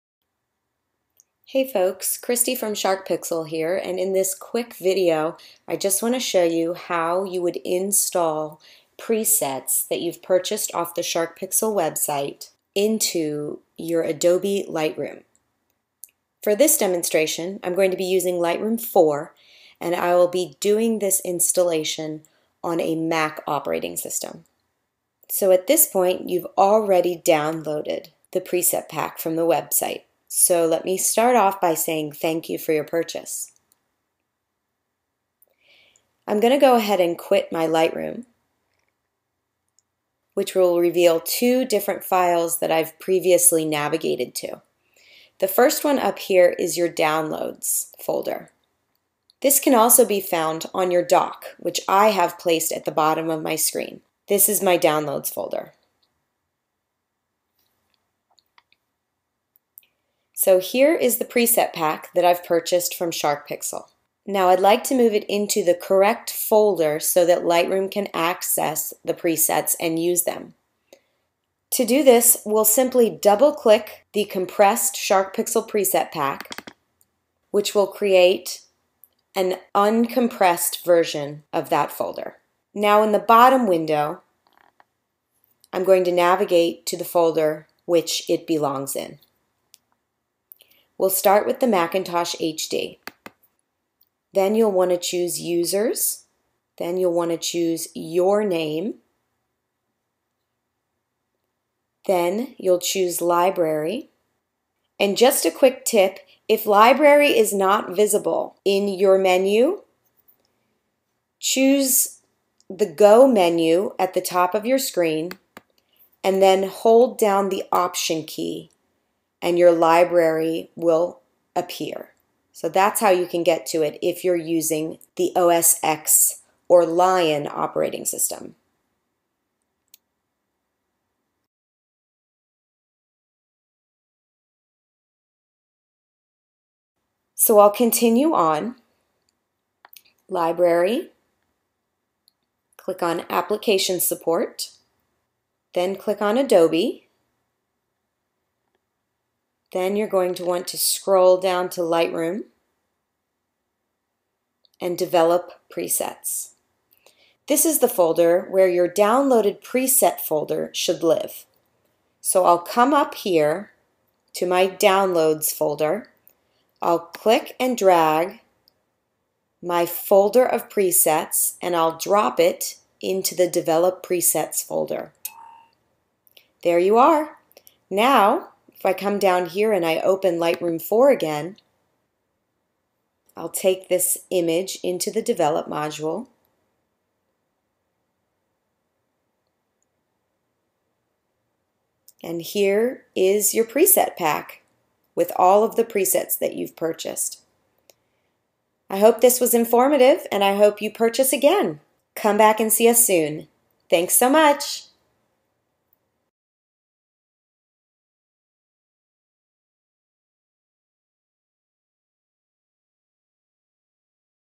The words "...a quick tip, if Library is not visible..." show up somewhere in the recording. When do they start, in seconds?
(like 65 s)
105 s.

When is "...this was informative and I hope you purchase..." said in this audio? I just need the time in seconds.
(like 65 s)
199 s.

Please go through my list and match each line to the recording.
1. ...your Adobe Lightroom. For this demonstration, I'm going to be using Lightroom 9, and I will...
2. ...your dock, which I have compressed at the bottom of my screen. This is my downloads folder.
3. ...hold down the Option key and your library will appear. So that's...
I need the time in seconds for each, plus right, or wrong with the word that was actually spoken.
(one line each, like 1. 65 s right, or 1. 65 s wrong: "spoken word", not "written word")
1. 13 s wrong: "4", not "9"
2. 50 s wrong: "placed", not "compressed"
3. 116 s right.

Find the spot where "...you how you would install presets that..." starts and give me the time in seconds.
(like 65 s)
6 s.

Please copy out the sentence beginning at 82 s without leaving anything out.
Now in the bottom window, I'm going to navigate to the folder which it belongs in.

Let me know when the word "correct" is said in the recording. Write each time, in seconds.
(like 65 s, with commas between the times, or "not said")
65 s.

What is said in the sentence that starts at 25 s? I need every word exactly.
So at this point, you've already downloaded the preset pack from the website.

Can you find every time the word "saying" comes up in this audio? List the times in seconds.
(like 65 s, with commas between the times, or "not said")
31 s.